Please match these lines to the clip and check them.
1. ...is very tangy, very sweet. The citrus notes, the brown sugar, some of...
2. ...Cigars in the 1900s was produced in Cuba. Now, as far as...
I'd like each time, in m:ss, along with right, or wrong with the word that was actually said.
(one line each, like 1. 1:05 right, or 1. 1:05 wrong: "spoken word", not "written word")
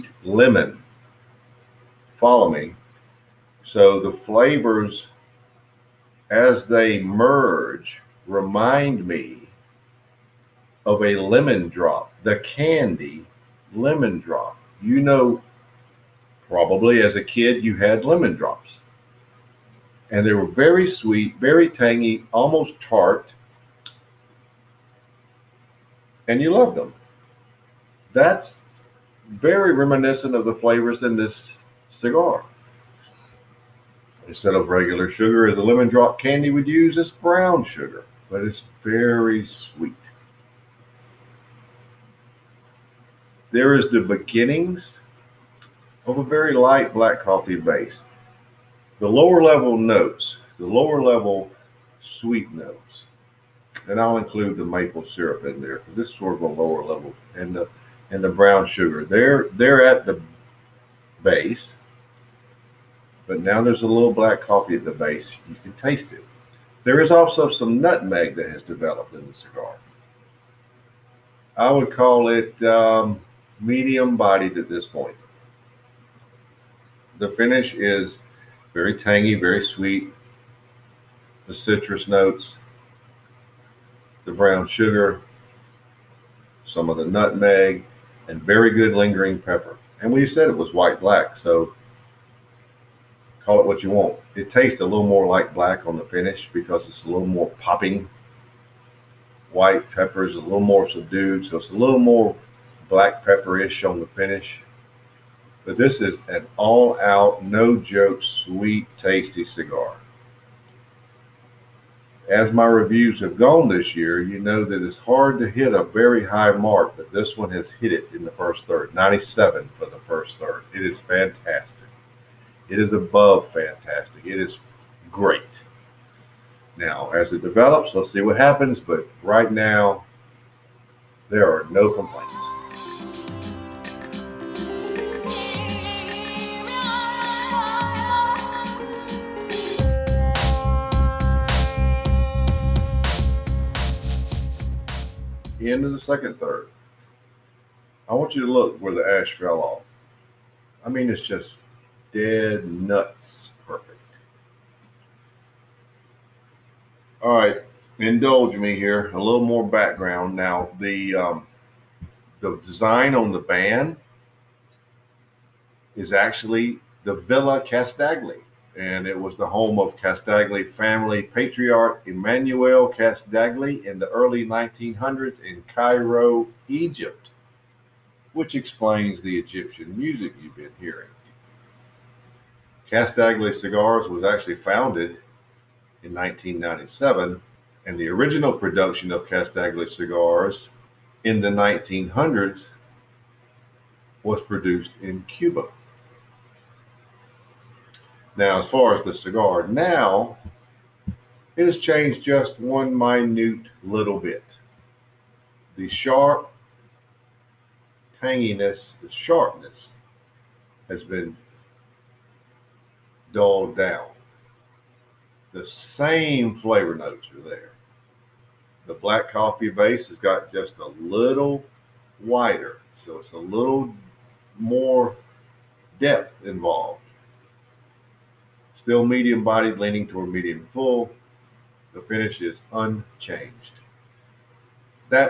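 1. 1:17 right
2. 3:09 right.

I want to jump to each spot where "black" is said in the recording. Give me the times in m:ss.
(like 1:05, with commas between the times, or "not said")
0:46, 1:04, 1:30, 1:35, 1:42, 3:38.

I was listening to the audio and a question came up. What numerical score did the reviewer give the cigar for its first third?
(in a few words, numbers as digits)
97.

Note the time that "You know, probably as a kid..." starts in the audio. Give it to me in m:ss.
0:14.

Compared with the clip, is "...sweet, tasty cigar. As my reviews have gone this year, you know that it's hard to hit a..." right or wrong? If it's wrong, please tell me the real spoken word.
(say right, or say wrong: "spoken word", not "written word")
right.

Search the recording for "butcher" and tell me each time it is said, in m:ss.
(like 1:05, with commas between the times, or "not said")
not said.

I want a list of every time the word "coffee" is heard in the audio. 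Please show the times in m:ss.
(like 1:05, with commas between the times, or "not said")
0:47, 1:04, 3:39.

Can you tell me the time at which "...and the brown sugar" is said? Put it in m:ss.
0:58.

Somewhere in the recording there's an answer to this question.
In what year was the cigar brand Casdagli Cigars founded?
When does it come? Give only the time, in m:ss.
3:06.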